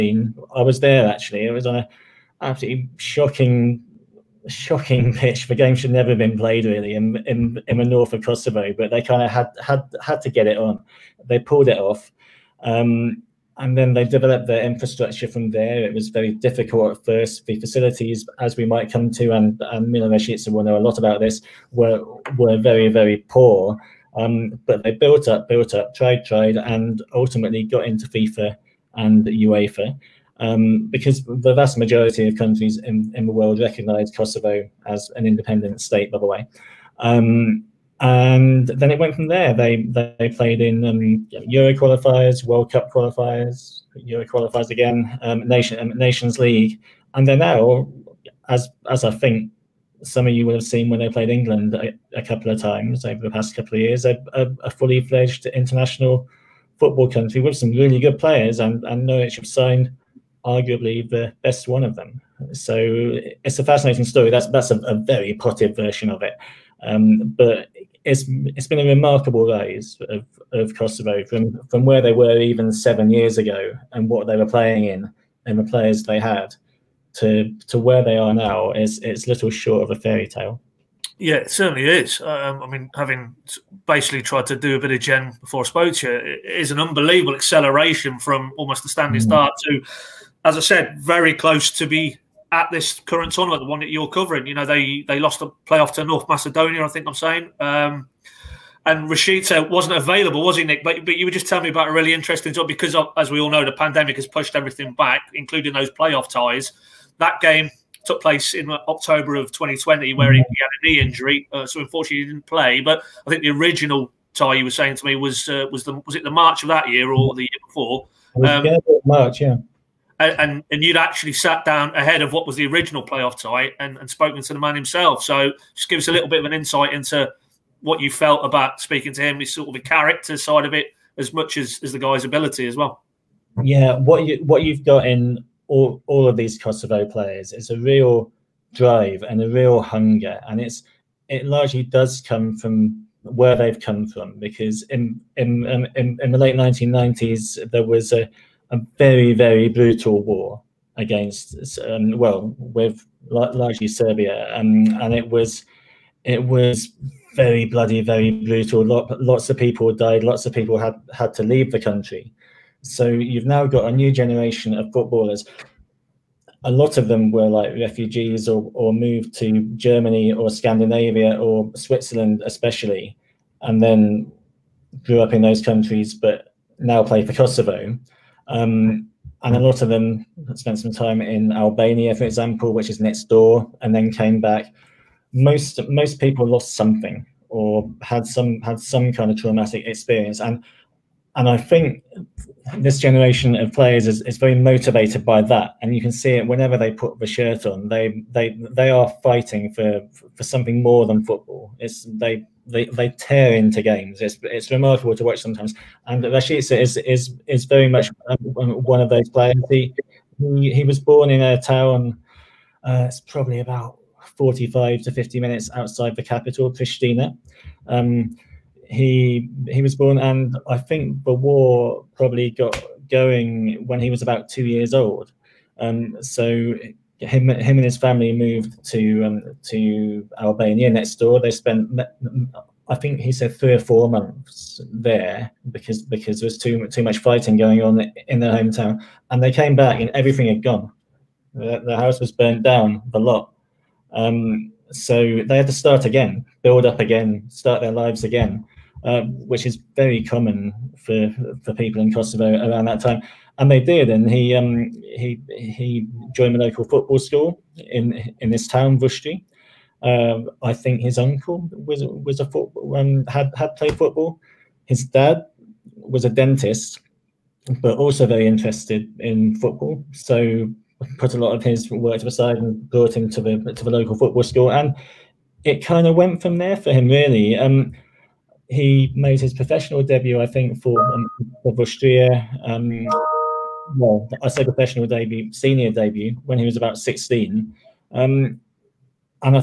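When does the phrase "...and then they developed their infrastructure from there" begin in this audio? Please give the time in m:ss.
0:13.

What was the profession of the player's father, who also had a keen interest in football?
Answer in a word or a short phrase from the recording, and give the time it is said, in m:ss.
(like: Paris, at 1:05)
Dentist, at 4:26.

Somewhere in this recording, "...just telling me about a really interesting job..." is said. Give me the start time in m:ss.
1:41.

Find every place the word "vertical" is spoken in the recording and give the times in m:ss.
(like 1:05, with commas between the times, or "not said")
not said.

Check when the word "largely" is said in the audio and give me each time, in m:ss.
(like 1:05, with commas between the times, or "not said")
2:21, 2:33.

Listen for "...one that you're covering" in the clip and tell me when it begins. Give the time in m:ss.
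1:33.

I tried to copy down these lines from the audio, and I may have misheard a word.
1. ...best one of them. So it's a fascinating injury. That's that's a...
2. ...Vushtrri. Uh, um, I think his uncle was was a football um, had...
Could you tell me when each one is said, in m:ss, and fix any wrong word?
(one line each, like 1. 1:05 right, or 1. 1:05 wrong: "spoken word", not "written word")
1. 1:01 wrong: "story", not "injury"
2. 4:18 right.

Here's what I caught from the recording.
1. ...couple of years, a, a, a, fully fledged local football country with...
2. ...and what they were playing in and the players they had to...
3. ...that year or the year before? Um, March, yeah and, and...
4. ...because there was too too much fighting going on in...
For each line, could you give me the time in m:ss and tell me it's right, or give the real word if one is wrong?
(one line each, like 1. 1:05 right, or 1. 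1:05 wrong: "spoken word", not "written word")
1. 0:53 wrong: "international", not "local"
2. 1:13 right
3. 1:56 right
4. 3:56 right.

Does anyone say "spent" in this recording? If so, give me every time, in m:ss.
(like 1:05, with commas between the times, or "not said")
3:00, 3:51.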